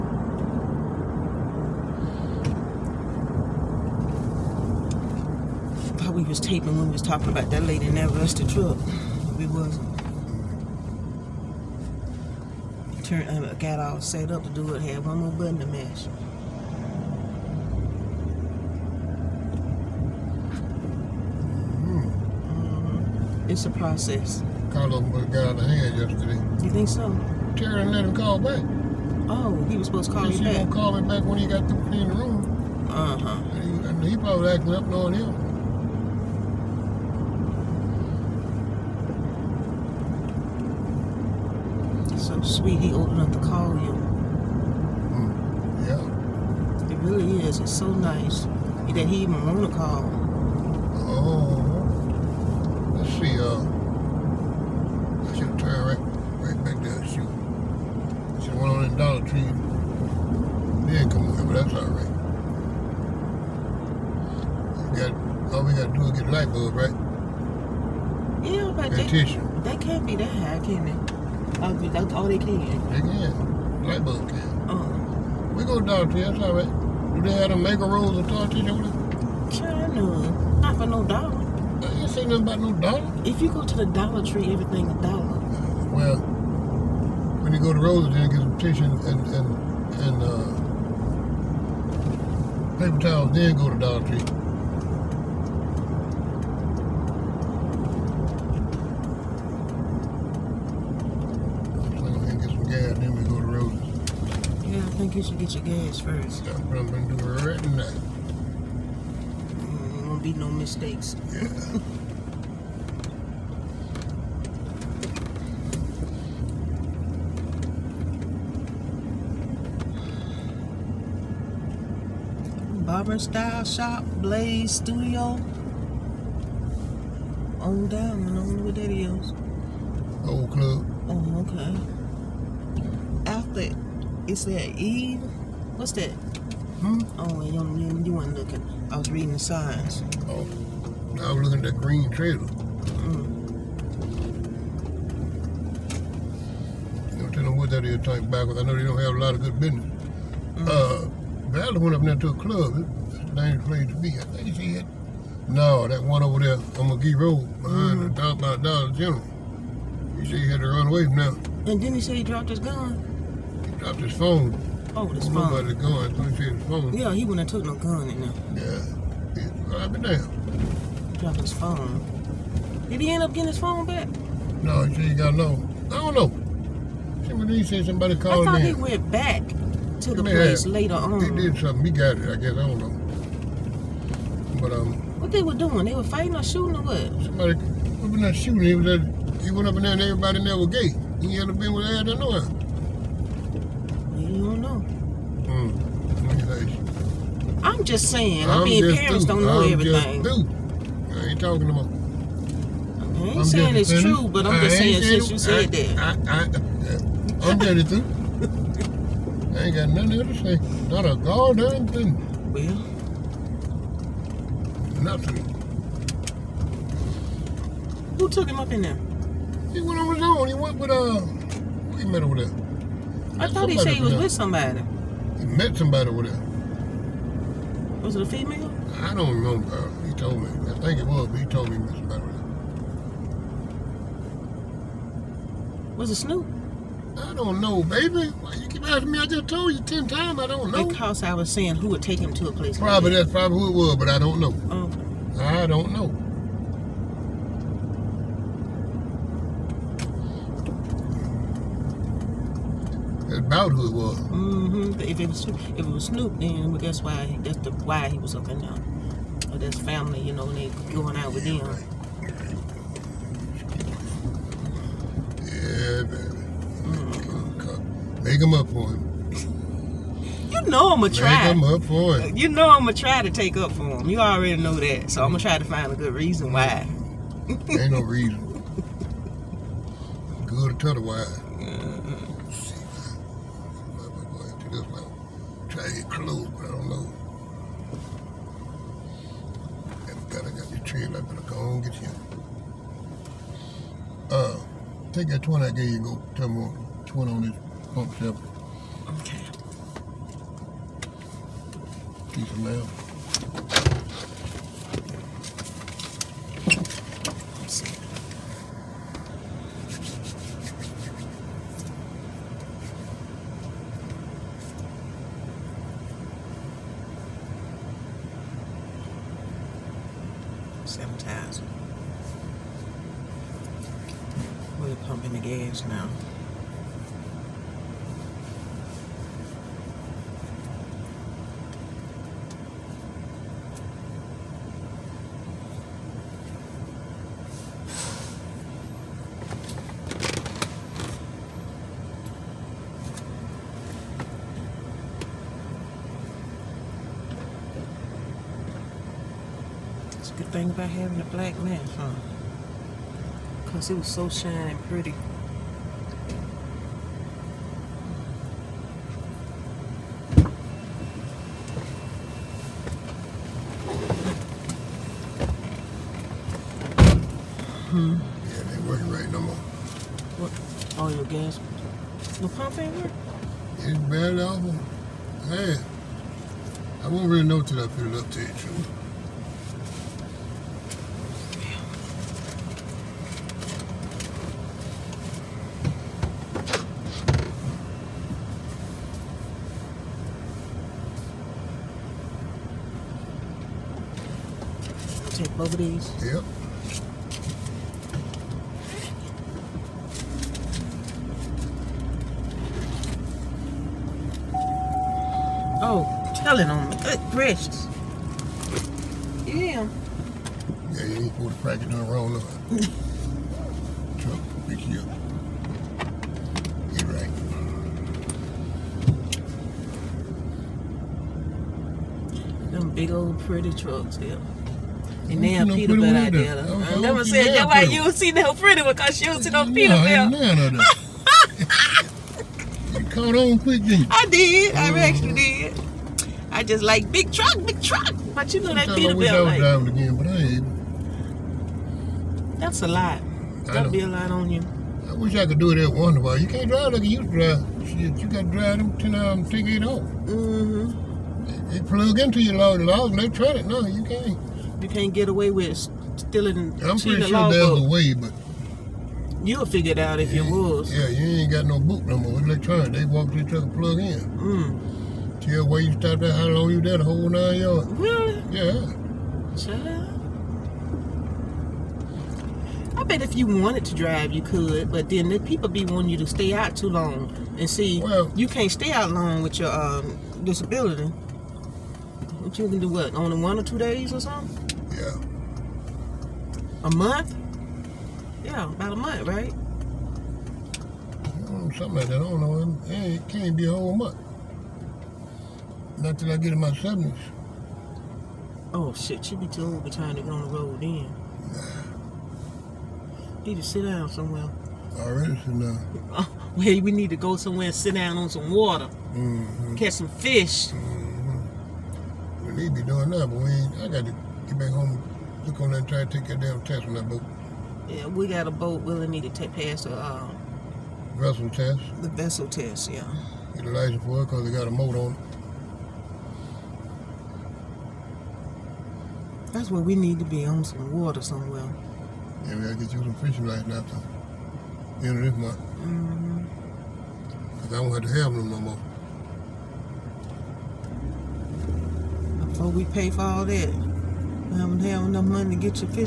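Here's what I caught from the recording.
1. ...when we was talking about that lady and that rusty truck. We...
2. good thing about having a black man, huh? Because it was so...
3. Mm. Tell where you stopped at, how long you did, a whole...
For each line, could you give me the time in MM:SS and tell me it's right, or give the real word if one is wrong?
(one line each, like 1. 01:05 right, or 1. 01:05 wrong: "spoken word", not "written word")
1. 00:06 right
2. 05:50 right
3. 07:44 right.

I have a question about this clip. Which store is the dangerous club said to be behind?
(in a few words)
Dollar General.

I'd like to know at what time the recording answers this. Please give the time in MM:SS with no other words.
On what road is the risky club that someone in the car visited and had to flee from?
02:36.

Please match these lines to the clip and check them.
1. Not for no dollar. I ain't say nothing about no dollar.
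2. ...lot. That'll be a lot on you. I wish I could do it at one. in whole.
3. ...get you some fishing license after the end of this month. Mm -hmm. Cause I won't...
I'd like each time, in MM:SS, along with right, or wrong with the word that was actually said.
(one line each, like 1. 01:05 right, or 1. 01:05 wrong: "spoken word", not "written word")
1. 01:20 right
2. 07:22 wrong: "while", not "whole"
3. 08:52 right.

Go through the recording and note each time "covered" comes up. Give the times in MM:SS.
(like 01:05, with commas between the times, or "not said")
not said.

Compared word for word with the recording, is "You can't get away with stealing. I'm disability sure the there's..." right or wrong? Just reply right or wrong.
wrong.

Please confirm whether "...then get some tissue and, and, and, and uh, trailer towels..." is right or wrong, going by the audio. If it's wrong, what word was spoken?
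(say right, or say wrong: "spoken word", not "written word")
wrong: "paper", not "trailer".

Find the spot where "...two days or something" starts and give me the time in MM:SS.
08:03.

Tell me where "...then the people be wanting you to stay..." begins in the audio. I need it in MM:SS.
07:55.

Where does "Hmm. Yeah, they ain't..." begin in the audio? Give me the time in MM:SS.
06:07.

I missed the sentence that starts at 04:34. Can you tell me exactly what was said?
You already know that, so I'm gonna try to find a good reason why.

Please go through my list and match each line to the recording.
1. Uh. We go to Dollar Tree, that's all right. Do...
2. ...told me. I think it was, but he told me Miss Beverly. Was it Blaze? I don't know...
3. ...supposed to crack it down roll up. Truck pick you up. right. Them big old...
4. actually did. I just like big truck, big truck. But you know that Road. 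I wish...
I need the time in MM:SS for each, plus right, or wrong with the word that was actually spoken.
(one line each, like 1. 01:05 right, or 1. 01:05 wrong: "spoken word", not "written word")
1. 01:14 right
2. 03:50 wrong: "Snoop", not "Blaze"
3. 06:51 right
4. 07:14 wrong: "Peterbilt", not "Road".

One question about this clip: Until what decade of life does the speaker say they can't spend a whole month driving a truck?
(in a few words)
70s.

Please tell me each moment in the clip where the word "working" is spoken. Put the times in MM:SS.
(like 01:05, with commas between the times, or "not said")
06:08, 06:12.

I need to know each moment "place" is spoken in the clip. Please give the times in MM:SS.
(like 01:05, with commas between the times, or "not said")
02:33, 03:00, 04:02.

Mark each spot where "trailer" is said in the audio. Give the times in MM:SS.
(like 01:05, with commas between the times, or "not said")
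02:22.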